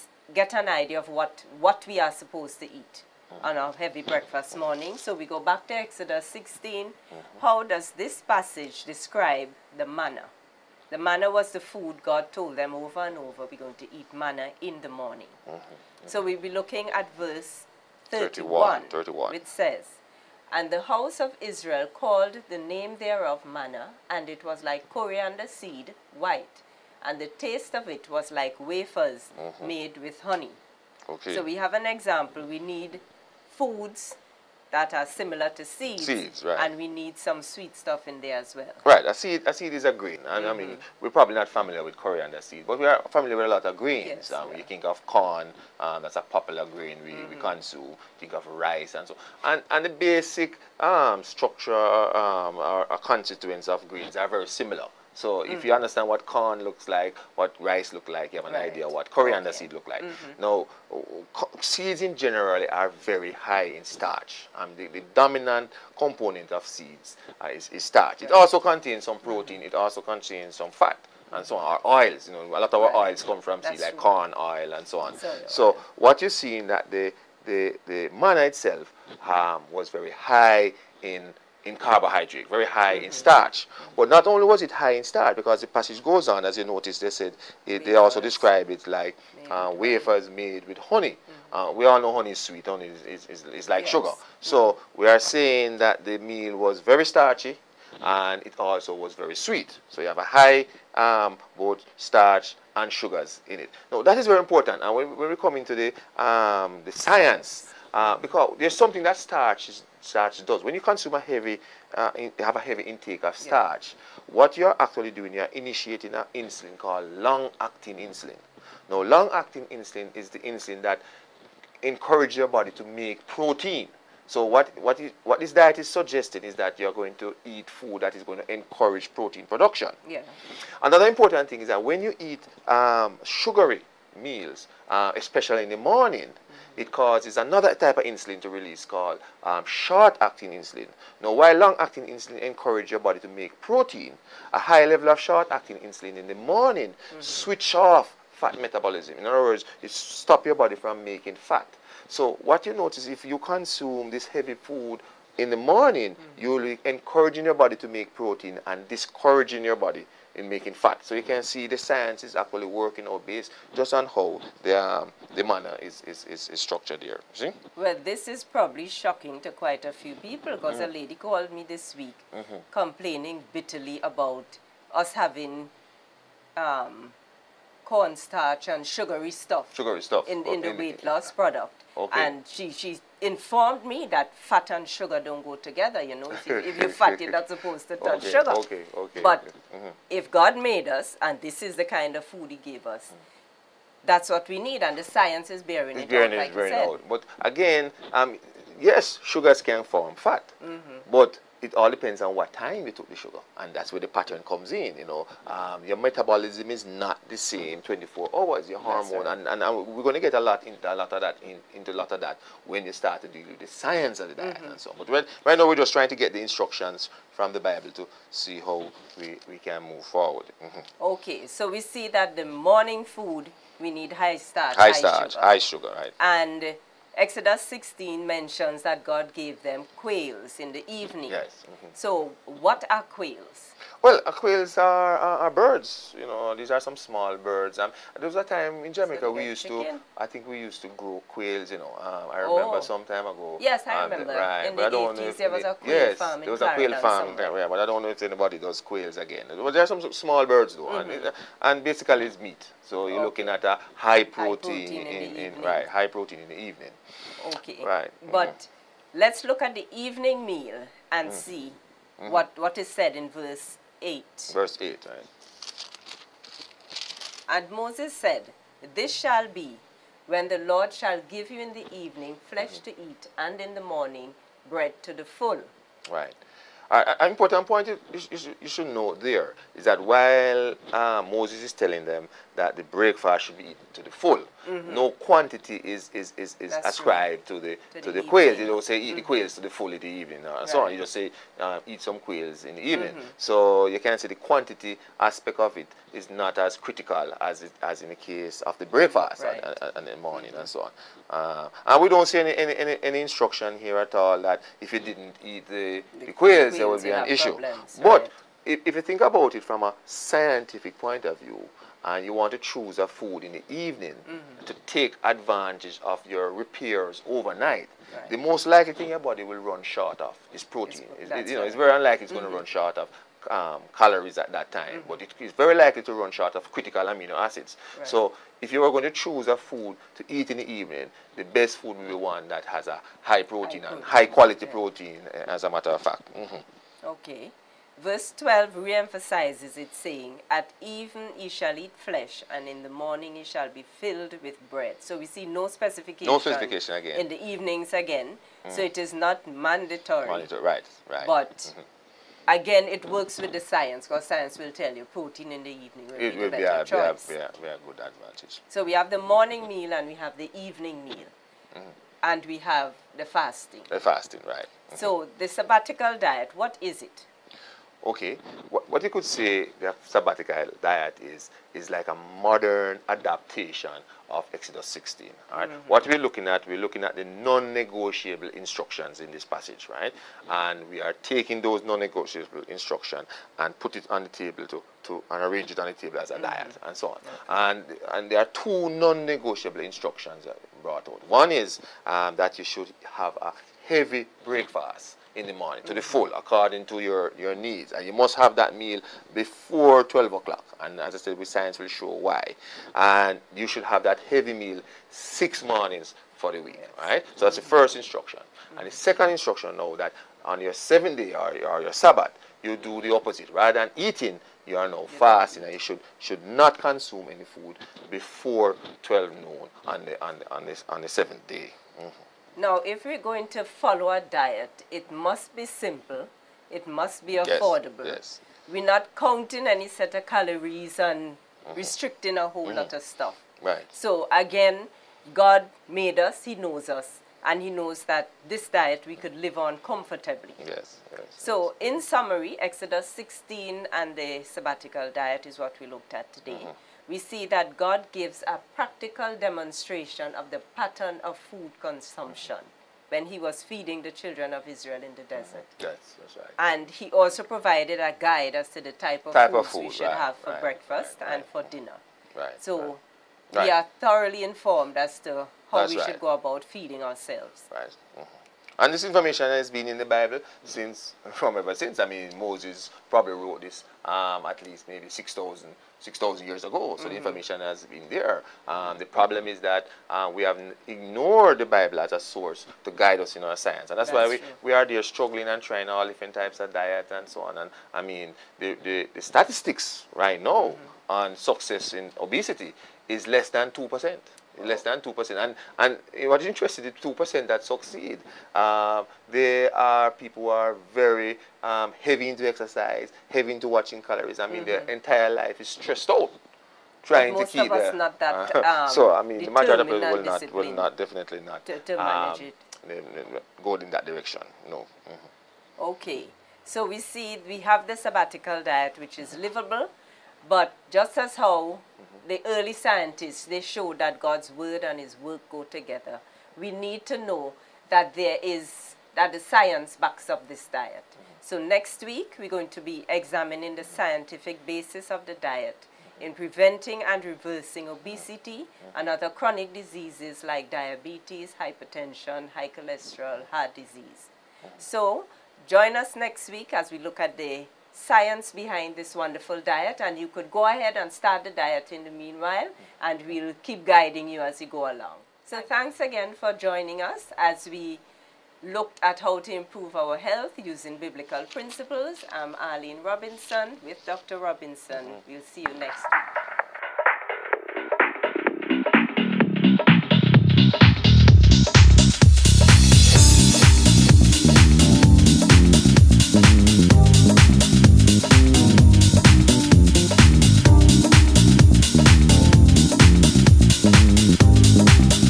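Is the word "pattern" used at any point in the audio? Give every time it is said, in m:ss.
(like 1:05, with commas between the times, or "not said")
3:24, 7:30.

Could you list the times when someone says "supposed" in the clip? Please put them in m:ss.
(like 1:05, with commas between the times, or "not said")
0:02, 3:07.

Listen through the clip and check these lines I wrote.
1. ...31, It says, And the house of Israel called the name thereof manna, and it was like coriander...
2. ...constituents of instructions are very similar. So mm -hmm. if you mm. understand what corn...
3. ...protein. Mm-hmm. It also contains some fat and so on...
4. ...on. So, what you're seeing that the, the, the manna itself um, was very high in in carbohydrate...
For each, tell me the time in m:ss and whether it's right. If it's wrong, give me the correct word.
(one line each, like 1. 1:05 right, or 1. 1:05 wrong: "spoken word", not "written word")
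1. 0:18 right
2. 0:53 wrong: "greens", not "instructions"
3. 1:09 right
4. 1:14 right.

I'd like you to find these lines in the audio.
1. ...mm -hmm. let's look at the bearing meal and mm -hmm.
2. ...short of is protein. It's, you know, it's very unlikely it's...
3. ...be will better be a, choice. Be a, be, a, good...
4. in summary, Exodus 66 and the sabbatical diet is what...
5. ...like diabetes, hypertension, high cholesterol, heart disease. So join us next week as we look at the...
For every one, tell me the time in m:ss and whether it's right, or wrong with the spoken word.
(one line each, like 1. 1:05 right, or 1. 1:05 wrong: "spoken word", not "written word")
1. 4:18 wrong: "evening", not "bearing"
2. 5:19 right
3. 5:56 right
4. 7:21 wrong: "16", not "66"
5. 9:00 right.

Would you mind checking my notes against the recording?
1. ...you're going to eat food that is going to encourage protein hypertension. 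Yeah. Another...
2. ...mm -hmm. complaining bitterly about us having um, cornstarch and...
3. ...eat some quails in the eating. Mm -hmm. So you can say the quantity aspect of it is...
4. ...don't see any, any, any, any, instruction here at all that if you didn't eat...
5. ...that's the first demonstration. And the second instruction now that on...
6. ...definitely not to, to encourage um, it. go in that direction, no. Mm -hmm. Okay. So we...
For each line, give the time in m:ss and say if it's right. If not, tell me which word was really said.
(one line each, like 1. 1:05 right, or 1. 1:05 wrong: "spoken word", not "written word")
1. 2:06 wrong: "production", not "hypertension"
2. 2:52 right
3. 4:51 wrong: "evening", not "eating"
4. 5:02 right
5. 6:47 wrong: "instruction", not "demonstration"
6. 8:30 wrong: "manage", not "encourage".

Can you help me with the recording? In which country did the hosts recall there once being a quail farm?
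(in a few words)
Jamaica.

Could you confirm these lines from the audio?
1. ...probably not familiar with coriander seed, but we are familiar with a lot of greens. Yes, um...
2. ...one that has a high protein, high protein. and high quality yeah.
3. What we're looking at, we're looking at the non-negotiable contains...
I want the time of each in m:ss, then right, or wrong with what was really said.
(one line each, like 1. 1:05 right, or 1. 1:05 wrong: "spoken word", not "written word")
1. 0:41 right
2. 5:32 right
3. 6:15 wrong: "instructions", not "contains".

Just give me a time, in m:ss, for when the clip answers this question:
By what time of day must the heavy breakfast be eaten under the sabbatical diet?
6:40.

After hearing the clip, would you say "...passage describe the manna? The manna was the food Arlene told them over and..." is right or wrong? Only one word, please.
wrong.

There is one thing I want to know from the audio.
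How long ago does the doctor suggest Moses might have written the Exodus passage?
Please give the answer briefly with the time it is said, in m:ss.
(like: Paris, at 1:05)
6,000 years, at 7:55.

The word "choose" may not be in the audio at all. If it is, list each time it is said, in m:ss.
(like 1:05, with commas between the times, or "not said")
5:12, 5:29.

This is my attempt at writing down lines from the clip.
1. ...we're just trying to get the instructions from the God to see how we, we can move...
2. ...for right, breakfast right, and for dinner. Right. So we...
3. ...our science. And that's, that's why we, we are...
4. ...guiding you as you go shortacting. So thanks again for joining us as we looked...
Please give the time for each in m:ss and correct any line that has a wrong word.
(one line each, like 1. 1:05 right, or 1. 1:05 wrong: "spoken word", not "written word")
1. 3:35 wrong: "Bible", not "God"
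2. 7:40 right
3. 8:03 right
4. 9:13 wrong: "along", not "shortacting".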